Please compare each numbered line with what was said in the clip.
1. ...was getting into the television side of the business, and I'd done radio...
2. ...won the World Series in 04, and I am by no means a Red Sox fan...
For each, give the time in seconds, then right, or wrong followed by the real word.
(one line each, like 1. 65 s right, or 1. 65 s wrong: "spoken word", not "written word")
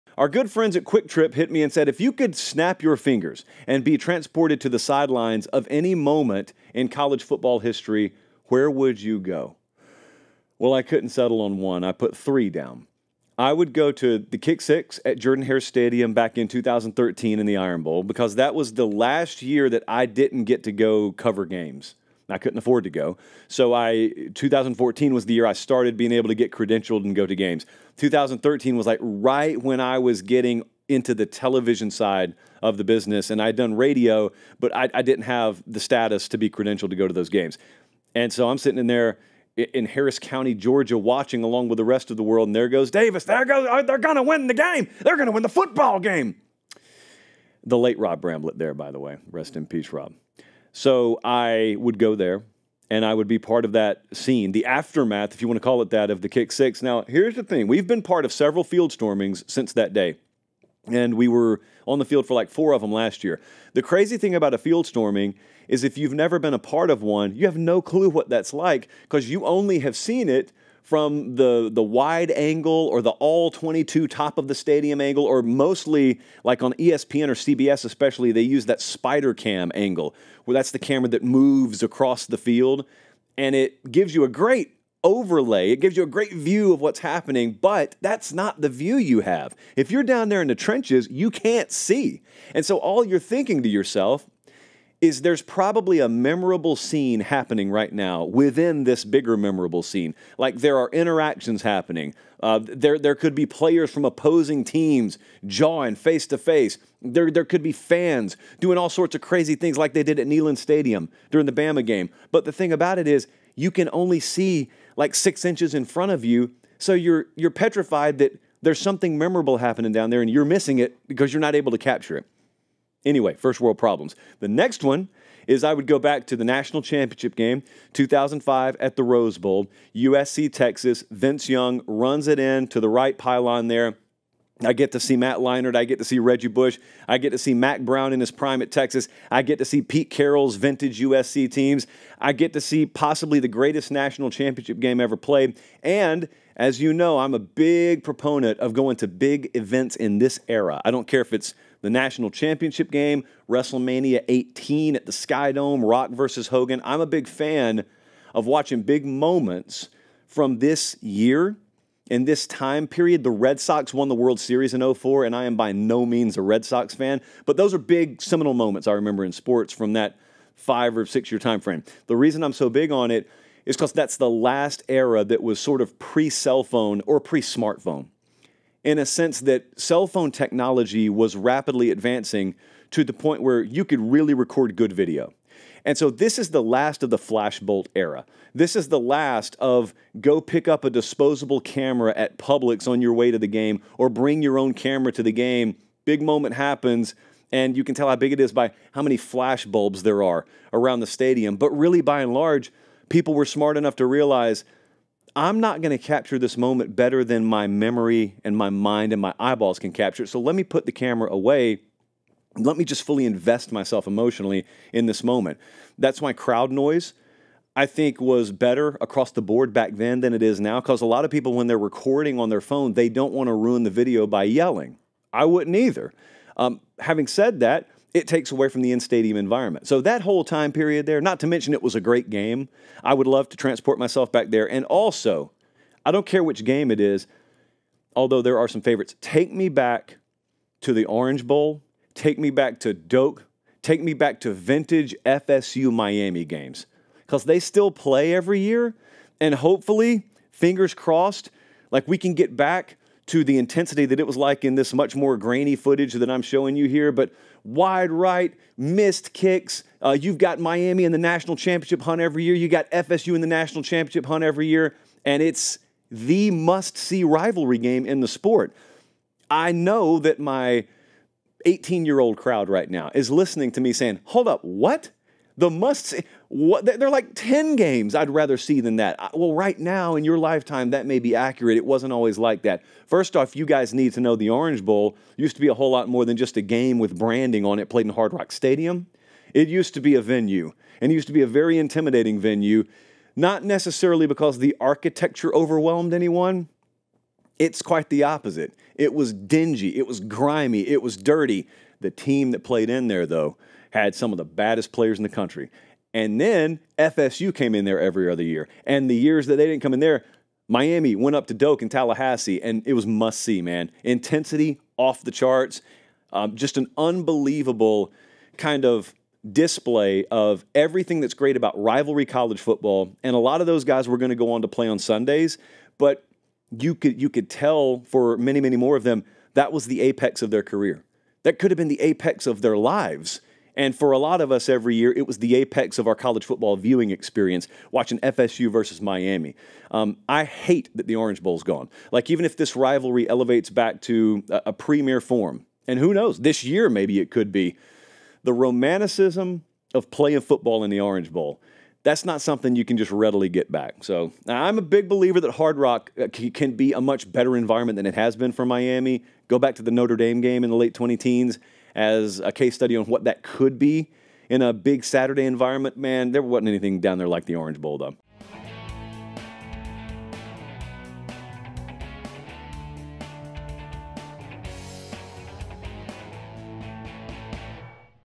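1. 29 s right
2. 163 s right.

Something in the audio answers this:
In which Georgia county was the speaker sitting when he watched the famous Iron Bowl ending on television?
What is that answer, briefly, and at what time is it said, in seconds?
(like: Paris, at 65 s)
Harris County, at 39 s.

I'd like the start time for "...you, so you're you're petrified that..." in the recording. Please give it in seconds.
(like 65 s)
116 s.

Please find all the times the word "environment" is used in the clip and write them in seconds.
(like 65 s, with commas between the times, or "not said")
229 s, 357 s, 365 s.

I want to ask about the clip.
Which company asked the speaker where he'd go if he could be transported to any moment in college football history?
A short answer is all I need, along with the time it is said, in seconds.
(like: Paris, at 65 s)
QuikTrip, at 0 s.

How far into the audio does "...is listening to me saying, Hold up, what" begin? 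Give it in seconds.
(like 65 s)
273 s.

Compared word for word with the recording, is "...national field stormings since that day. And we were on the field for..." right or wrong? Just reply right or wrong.
wrong.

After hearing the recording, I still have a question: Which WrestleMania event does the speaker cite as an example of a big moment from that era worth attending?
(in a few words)
WrestleMania 18.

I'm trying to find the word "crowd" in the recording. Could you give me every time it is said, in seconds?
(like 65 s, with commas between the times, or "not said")
216 s, 272 s.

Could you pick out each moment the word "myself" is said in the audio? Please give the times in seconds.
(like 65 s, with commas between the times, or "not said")
213 s, 233 s.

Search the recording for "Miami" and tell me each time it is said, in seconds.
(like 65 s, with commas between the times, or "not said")
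245 s, 260 s, 310 s, 339 s, 358 s.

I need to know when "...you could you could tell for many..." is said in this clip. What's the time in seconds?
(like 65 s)
326 s.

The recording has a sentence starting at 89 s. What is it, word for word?
If you're down there in the trenches, you can't see.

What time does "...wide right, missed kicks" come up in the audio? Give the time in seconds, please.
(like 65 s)
257 s.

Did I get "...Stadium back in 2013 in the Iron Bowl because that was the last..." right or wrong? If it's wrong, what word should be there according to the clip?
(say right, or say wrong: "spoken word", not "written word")
right.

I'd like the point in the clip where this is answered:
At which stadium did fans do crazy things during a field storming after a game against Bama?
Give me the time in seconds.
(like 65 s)
110 s.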